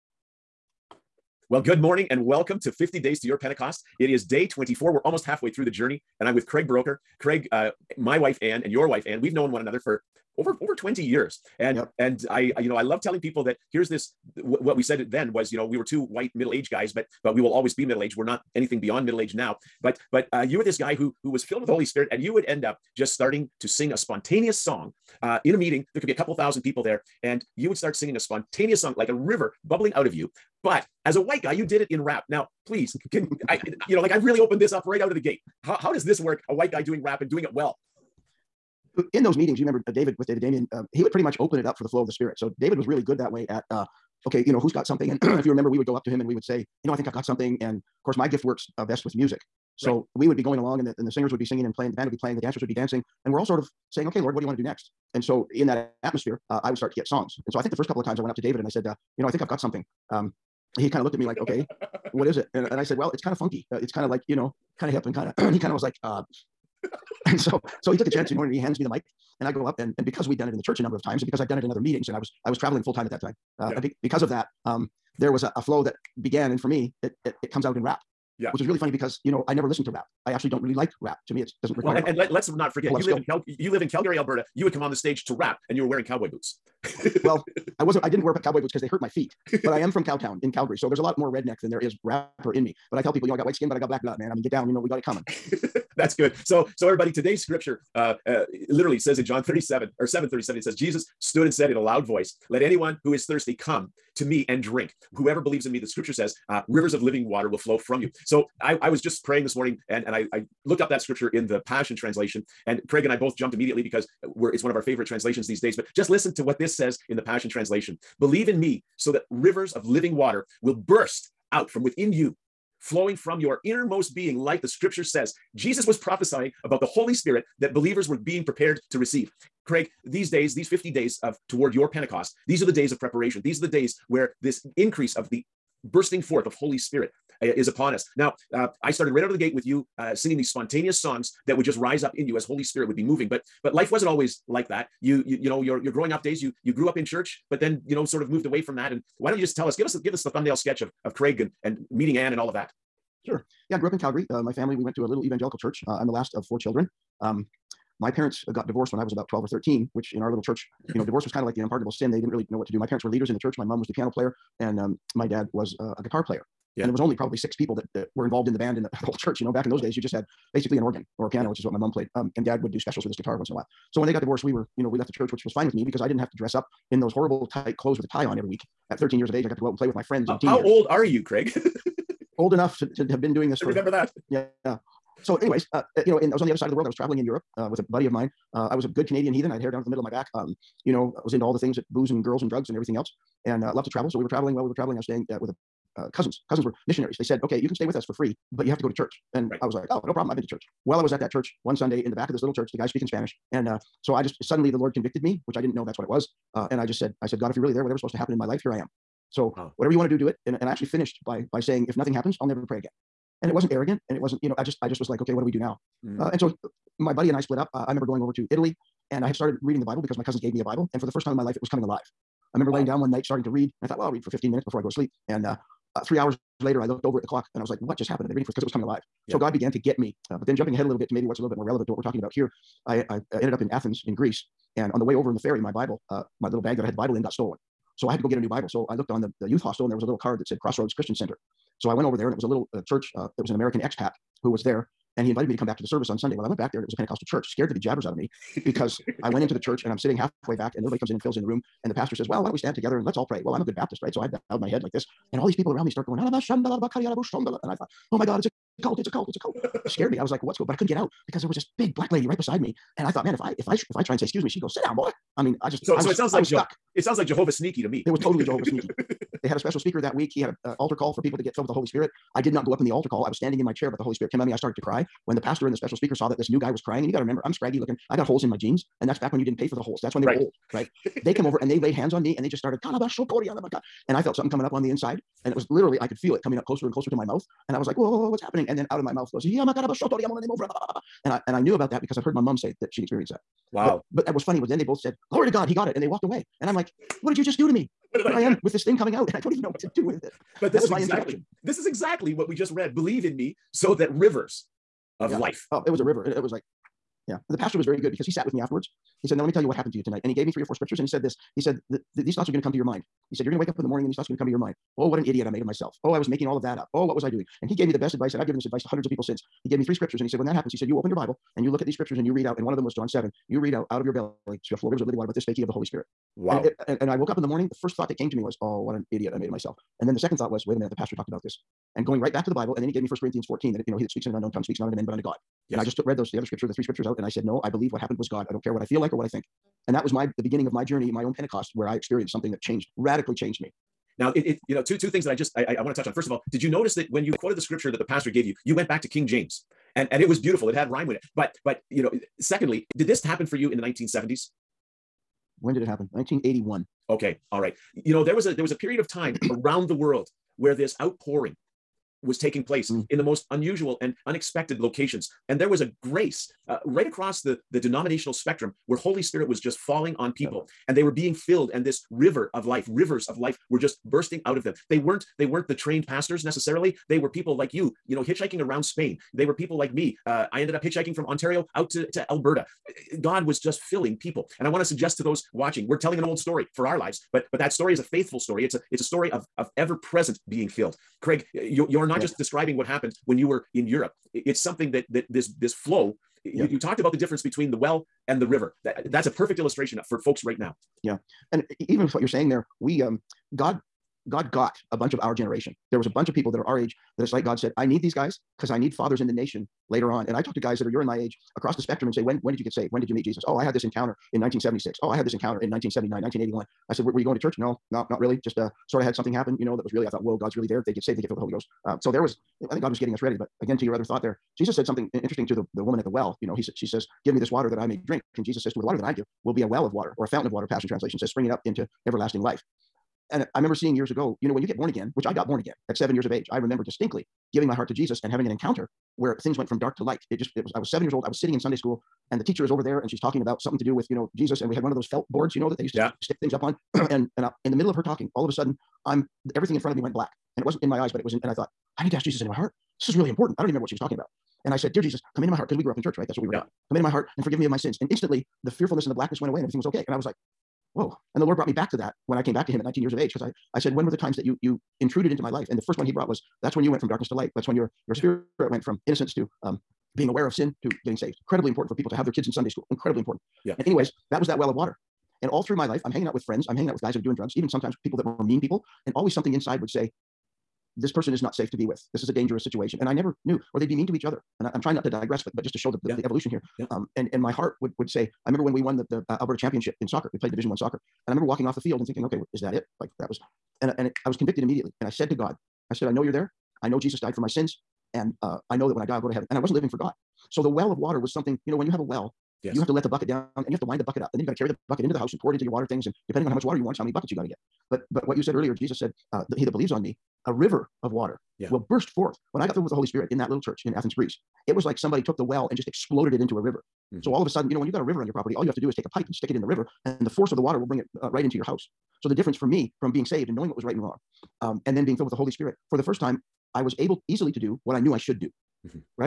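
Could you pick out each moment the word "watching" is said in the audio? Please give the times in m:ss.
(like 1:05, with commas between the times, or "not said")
6:25.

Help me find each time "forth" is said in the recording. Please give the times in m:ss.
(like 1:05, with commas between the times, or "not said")
2:16, 8:32.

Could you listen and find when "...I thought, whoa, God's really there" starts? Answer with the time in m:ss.
7:00.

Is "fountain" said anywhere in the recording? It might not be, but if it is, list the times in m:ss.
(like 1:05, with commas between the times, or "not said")
7:10.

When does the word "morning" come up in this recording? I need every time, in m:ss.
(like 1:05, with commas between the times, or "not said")
0:01, 1:49, 5:13, 5:27.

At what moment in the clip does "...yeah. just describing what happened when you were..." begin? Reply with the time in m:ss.
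6:32.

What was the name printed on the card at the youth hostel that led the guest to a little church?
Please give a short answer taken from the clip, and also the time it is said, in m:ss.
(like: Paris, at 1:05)
Crossroads Christian Center, at 4:00.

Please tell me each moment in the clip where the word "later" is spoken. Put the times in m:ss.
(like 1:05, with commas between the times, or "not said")
3:46, 6:49.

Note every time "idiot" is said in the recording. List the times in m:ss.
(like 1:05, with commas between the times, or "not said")
5:15, 5:29.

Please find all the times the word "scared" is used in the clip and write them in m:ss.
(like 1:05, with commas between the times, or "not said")
4:07, 4:19.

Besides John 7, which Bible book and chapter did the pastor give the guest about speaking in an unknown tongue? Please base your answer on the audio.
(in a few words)
First Corinthians 14.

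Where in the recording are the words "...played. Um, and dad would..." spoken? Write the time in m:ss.
2:51.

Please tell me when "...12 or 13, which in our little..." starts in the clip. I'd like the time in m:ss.
2:39.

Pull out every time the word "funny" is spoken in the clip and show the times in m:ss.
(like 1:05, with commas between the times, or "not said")
1:18, 4:54.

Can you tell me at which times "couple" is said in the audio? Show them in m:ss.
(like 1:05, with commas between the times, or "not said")
0:26, 0:57.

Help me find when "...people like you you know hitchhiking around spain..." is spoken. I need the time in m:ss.
6:17.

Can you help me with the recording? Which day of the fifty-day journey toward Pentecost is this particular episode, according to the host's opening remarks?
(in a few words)
24.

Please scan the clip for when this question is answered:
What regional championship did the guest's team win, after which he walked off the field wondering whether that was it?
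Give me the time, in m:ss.
8:09.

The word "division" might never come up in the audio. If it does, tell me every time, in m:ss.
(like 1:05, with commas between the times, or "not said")
8:10.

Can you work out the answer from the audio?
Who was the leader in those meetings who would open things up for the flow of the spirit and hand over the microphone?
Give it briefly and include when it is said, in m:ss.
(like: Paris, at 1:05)
David Damien, at 0:40.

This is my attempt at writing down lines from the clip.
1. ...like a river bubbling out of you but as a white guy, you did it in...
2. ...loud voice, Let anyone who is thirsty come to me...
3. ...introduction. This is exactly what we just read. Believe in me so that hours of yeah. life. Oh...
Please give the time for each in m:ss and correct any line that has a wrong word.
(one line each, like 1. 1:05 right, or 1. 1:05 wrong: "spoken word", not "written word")
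1. 0:28 right
2. 1:41 right
3. 5:01 wrong: "rivers", not "hours".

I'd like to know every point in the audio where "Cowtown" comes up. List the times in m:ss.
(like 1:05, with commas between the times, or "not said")
1:30.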